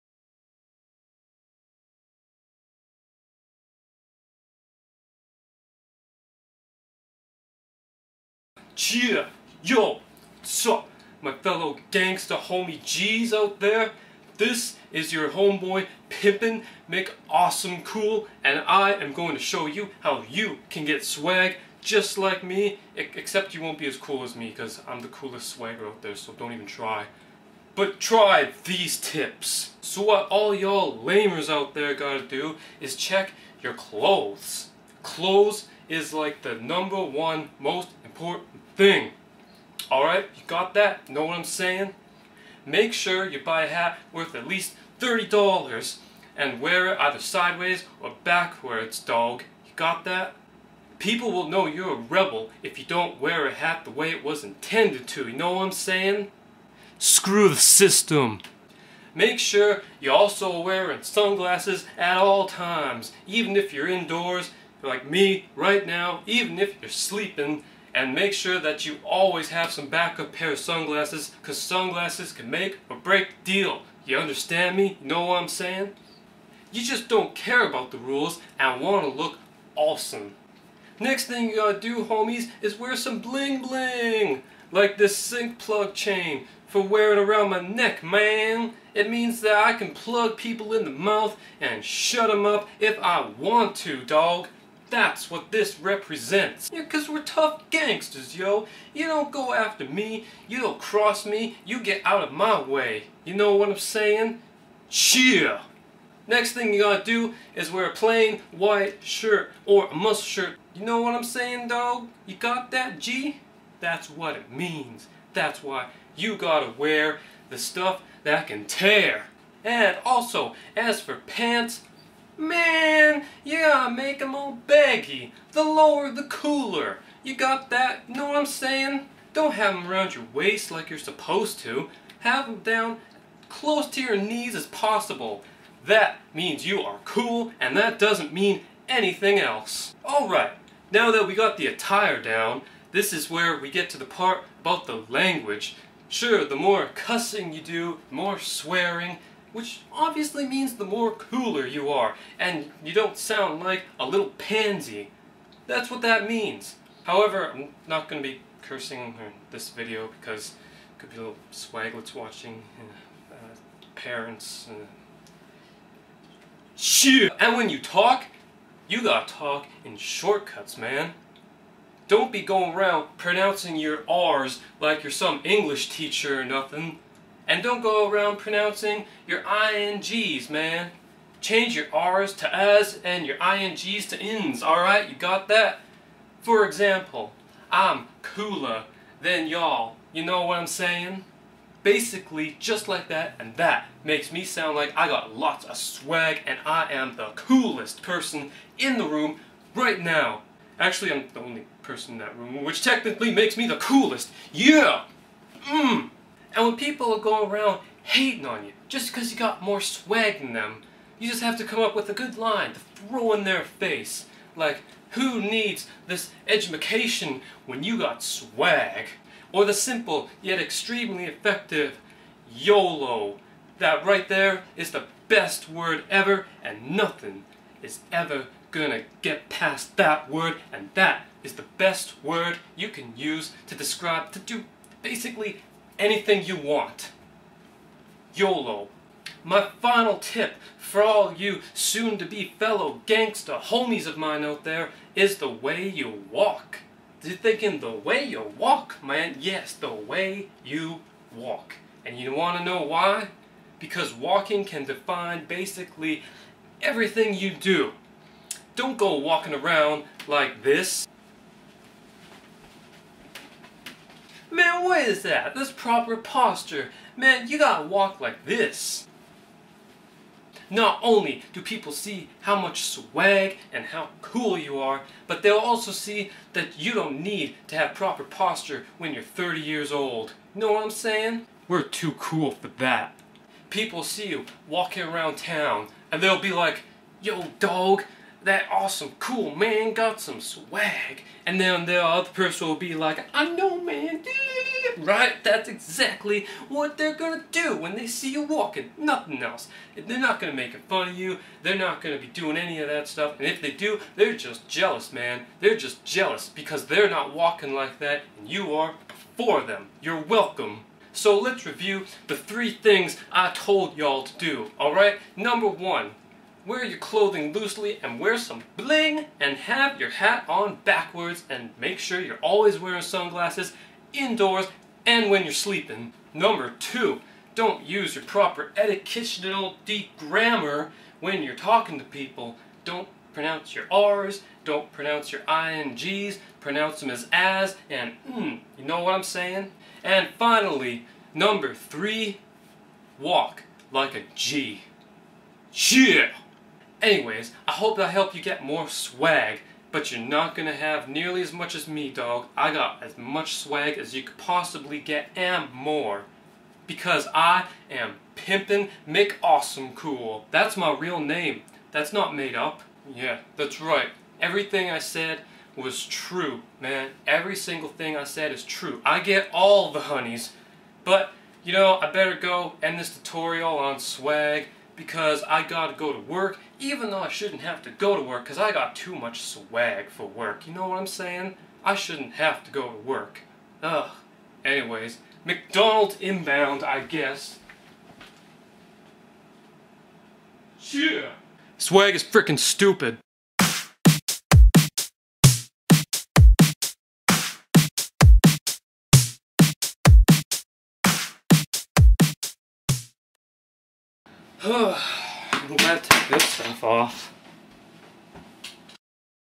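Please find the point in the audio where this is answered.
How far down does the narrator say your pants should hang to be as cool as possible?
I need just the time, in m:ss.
2:13.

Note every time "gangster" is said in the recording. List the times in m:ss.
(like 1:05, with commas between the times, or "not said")
0:11, 1:37, 4:03.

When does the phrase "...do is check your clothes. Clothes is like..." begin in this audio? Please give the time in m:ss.
0:32.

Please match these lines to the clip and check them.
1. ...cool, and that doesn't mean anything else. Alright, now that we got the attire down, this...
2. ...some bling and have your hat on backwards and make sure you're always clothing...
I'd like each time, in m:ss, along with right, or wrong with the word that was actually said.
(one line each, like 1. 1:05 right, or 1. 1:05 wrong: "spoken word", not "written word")
1. 2:17 right
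2. 5:18 wrong: "wearing", not "clothing".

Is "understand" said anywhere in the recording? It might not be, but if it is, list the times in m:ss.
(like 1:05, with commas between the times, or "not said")
1:14.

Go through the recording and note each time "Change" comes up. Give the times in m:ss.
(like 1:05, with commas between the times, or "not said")
3:01.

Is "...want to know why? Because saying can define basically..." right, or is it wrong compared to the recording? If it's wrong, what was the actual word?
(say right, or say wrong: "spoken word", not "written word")
wrong: "walking", not "saying".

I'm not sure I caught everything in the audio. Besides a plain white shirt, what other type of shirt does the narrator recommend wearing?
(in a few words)
muscle shirt.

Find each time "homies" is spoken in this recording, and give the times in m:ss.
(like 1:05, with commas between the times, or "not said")
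0:12, 1:22, 4:03.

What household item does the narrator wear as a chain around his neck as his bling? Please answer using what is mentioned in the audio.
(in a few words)
sink plug.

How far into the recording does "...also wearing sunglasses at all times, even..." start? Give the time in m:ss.
1:00.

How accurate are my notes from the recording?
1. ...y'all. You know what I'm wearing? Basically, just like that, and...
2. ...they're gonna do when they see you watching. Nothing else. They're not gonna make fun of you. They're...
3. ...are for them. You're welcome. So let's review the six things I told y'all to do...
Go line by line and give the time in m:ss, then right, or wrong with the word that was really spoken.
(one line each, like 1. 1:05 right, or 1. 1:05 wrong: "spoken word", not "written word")
1. 3:09 wrong: "saying", not "wearing"
2. 4:56 wrong: "walking", not "watching"
3. 5:08 wrong: "three", not "six".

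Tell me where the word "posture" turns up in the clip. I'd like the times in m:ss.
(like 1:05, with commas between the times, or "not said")
4:26, 4:38.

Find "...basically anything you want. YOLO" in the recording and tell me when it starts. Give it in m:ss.
3:55.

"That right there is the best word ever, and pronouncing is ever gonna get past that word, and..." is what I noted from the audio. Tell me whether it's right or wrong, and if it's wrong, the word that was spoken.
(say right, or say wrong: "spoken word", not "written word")
wrong: "nothing", not "pronouncing".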